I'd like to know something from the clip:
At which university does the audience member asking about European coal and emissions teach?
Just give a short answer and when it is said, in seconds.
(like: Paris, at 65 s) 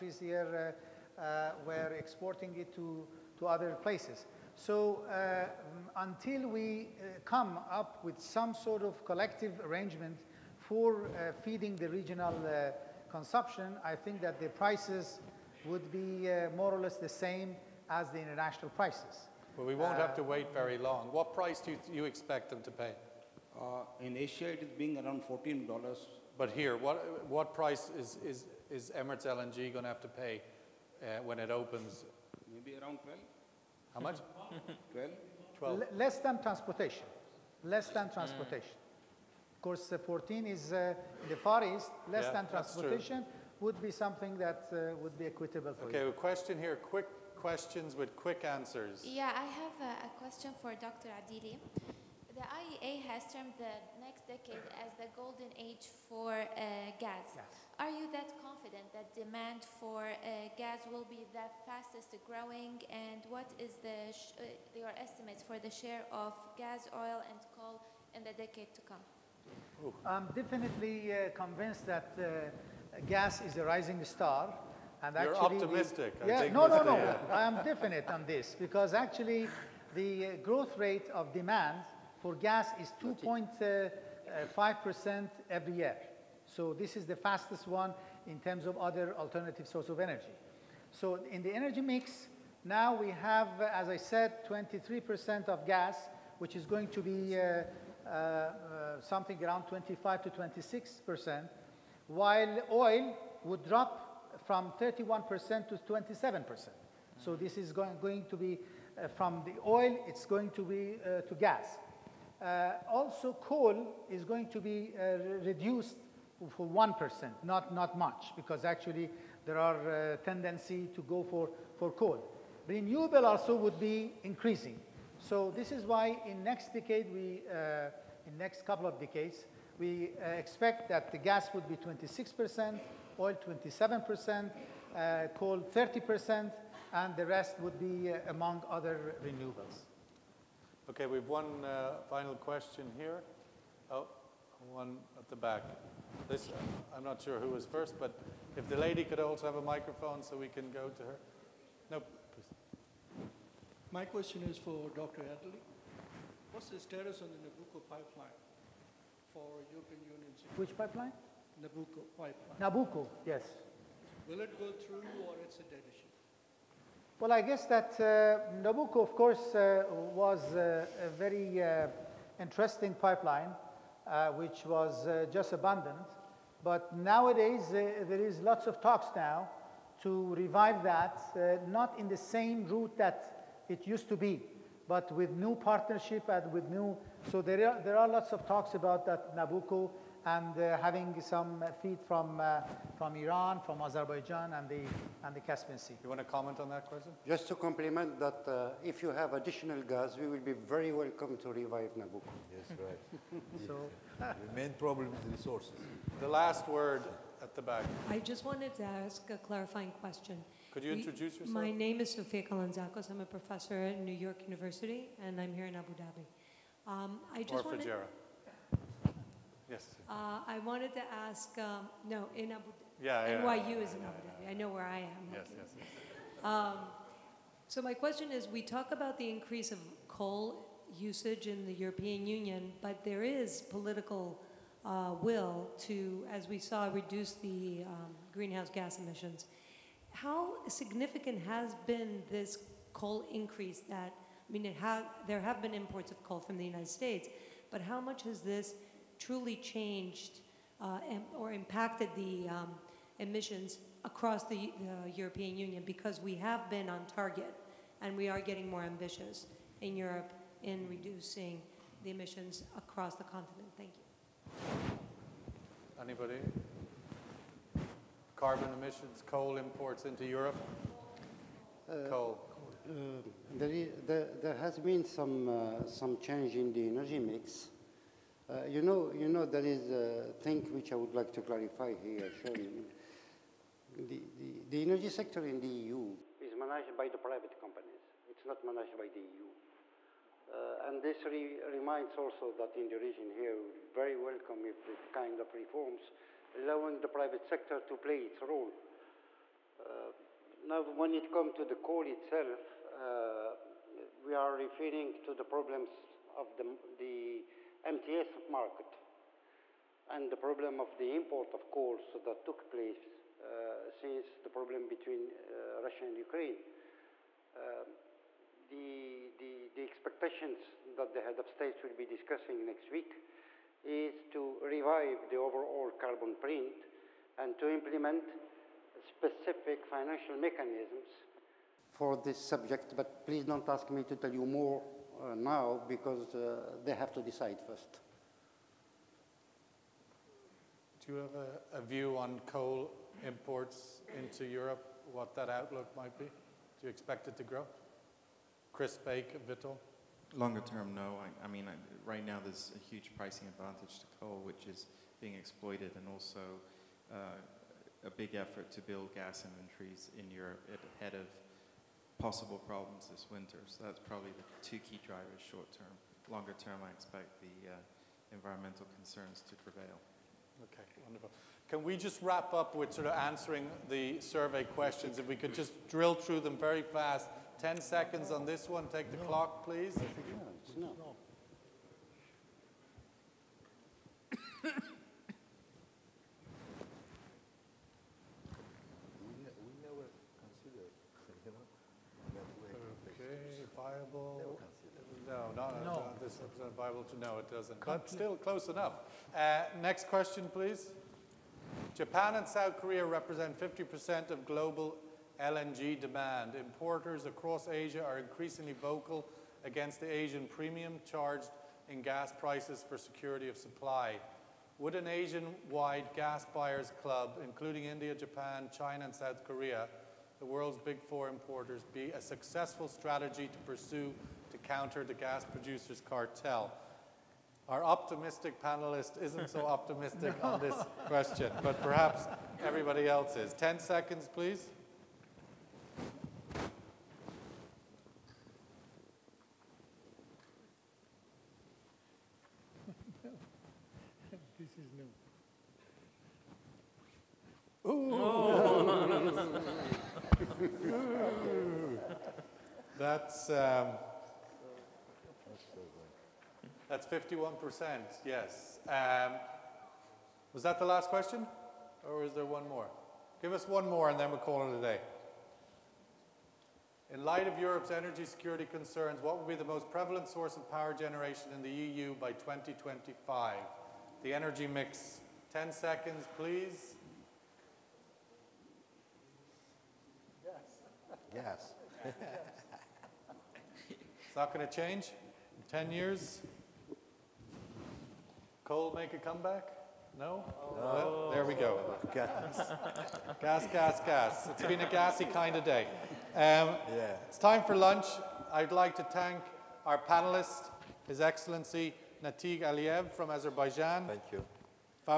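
New York University, at 213 s.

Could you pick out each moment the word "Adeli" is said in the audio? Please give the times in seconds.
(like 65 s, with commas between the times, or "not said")
51 s, 155 s.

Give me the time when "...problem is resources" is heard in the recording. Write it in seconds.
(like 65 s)
204 s.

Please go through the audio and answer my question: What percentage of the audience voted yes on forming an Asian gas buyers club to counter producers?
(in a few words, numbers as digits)
51%.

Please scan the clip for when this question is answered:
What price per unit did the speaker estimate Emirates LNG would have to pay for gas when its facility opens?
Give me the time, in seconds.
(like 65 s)
32 s.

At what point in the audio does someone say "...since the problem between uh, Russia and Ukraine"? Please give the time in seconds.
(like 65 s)
313 s.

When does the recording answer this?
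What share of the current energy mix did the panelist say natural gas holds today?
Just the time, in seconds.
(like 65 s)
94 s.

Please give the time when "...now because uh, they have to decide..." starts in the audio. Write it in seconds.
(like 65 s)
335 s.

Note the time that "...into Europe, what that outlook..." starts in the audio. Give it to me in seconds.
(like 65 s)
344 s.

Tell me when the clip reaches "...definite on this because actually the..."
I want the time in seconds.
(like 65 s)
77 s.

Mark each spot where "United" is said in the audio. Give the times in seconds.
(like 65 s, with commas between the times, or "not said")
246 s.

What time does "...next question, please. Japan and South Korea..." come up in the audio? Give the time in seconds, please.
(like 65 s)
399 s.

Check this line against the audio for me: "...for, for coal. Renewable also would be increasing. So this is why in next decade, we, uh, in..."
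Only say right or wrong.
right.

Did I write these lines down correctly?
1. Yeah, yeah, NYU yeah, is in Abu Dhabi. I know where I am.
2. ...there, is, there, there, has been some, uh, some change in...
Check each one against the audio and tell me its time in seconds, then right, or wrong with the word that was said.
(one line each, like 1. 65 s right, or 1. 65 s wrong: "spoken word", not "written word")
1. 223 s right
2. 273 s right.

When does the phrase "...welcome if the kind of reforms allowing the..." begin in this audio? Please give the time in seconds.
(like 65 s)
294 s.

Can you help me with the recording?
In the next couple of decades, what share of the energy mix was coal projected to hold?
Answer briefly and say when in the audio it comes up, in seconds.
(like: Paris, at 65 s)
30%, at 135 s.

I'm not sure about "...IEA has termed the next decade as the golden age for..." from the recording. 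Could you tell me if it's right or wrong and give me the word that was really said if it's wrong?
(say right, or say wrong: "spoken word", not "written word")
right.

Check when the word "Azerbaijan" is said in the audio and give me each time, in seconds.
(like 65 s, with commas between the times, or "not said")
193 s, 503 s.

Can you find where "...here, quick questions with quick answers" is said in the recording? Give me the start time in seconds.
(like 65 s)
46 s.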